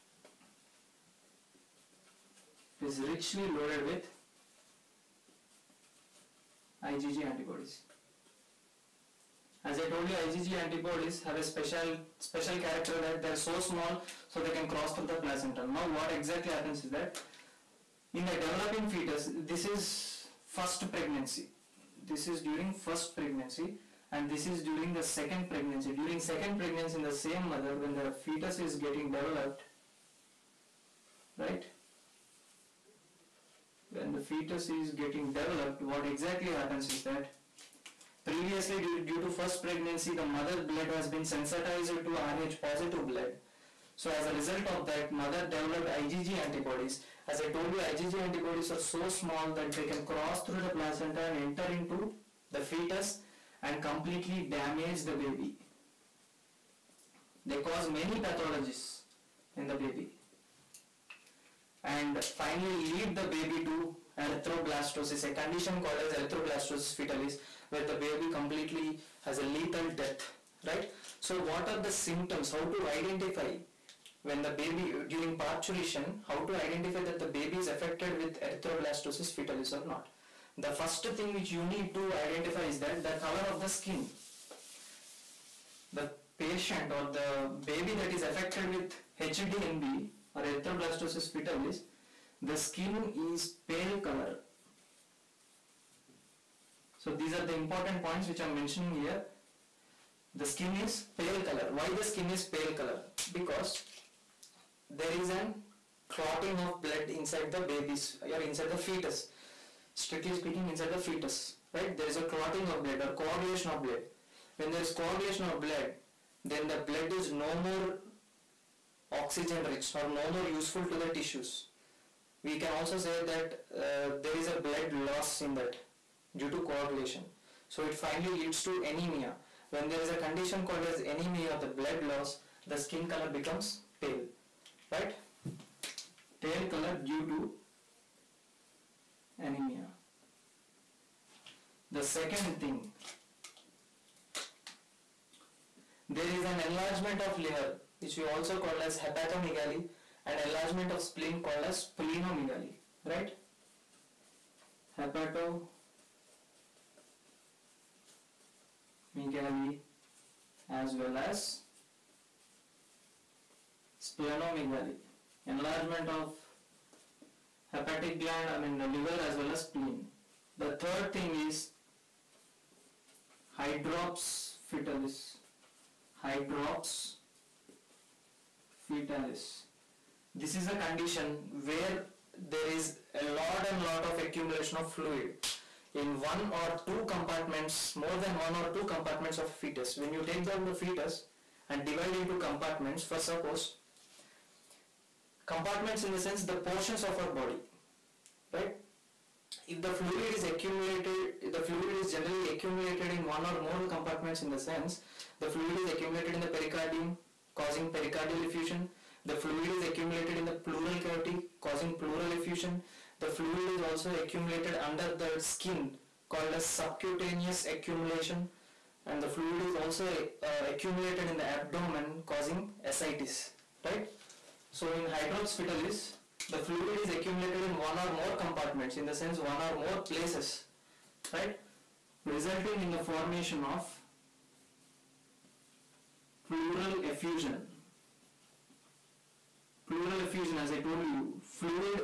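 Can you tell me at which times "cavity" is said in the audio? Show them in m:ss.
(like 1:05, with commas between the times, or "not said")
3:31.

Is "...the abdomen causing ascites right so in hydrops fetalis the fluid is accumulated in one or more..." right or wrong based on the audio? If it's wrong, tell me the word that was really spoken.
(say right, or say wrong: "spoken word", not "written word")
right.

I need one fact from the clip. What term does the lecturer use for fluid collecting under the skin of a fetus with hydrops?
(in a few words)
Subcutaneous accumulation.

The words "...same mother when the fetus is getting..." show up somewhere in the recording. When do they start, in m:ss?
0:27.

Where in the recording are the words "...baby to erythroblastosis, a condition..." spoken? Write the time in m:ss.
1:03.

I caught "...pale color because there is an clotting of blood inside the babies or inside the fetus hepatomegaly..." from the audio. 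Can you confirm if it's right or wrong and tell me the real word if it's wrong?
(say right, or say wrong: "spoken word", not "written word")
wrong: "strictly", not "hepatomegaly".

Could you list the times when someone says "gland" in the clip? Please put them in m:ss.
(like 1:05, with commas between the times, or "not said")
2:48.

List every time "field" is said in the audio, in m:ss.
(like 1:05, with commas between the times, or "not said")
not said.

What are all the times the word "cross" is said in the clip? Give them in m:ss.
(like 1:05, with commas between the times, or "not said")
0:14, 0:50.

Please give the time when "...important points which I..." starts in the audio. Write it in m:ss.
1:37.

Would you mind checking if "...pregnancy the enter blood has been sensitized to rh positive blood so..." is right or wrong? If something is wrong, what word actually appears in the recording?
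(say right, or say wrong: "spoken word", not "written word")
wrong: "mother", not "enter".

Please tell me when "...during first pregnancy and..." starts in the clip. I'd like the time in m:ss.
0:22.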